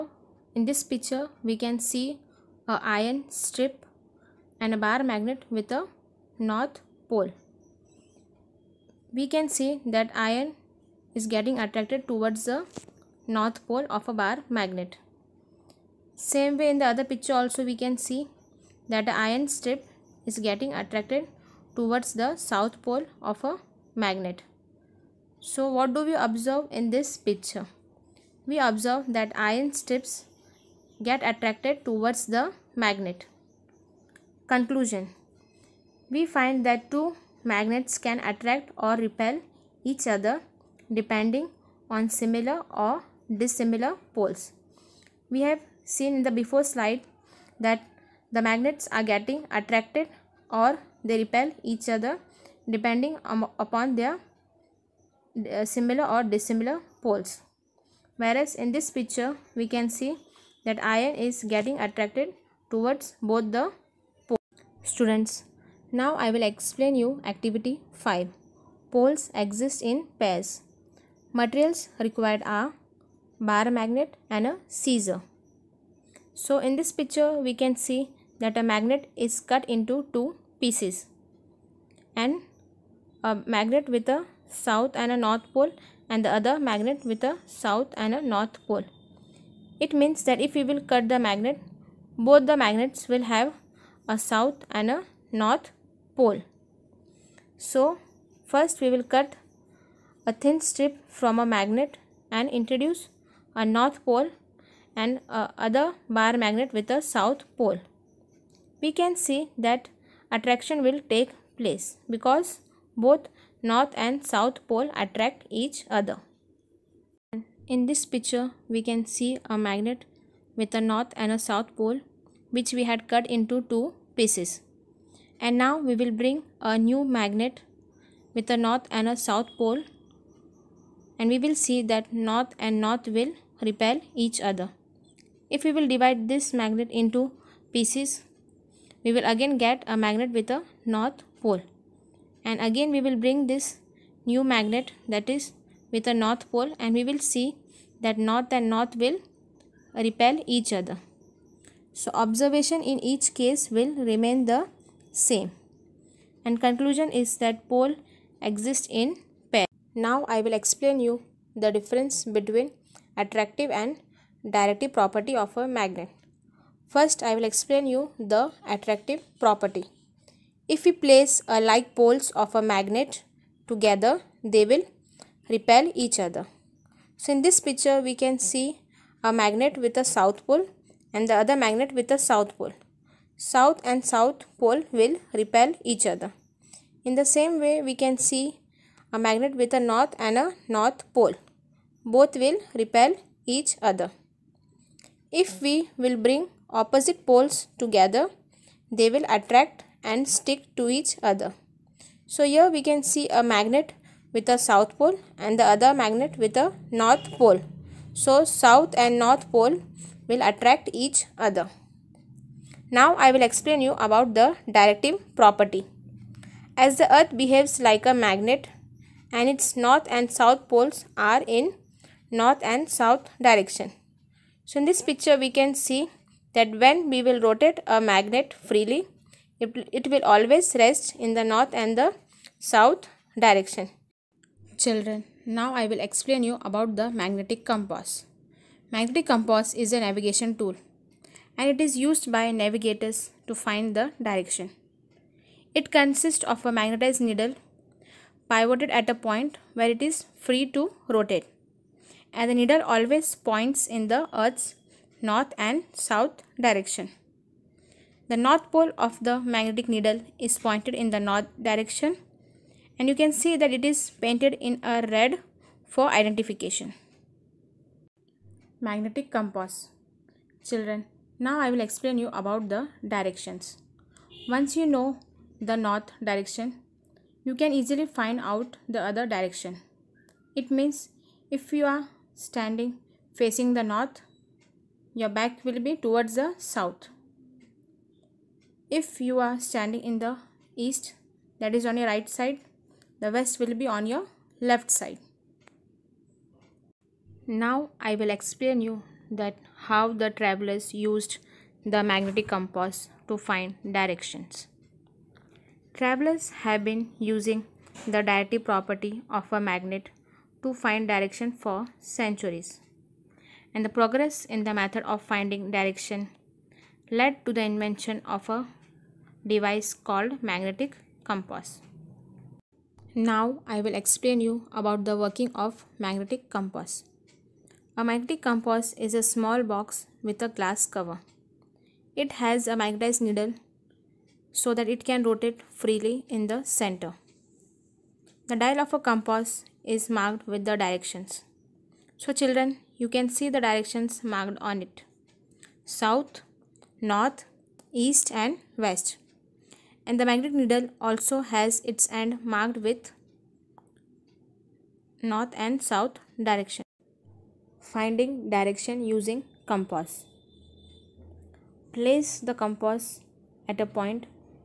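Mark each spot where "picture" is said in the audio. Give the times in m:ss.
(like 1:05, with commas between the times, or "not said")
0:00, 0:17, 0:27, 0:58, 1:16, 1:58, 2:57, 3:45.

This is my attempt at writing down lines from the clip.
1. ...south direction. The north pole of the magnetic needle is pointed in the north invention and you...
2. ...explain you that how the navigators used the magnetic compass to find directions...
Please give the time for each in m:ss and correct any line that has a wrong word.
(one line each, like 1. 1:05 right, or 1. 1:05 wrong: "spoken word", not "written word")
1. 4:15 wrong: "direction", not "invention"
2. 4:58 wrong: "travelers", not "navigators".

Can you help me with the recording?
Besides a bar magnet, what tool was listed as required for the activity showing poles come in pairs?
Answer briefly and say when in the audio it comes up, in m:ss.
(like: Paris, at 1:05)
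Scissor, at 1:14.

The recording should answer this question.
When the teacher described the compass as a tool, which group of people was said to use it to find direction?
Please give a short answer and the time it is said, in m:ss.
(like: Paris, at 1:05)
Navigators, at 4:02.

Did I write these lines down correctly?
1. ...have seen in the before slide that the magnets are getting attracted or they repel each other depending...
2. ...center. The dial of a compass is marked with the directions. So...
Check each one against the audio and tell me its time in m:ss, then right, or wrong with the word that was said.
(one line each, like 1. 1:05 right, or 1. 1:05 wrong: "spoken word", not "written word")
1. 0:45 right
2. 5:36 right.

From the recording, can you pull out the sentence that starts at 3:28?
So south and north pole will attract each other.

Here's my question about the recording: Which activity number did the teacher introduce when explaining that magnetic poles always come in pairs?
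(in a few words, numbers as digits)
5.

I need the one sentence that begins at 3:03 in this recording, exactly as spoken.
South and south pole will repel each other.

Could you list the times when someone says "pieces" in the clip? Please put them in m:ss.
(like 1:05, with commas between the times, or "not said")
1:20, 2:04, 2:17.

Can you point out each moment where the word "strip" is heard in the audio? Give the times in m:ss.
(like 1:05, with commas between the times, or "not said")
0:03, 0:19, 0:29, 1:40.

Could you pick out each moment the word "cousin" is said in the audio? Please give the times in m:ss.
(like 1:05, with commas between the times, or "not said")
not said.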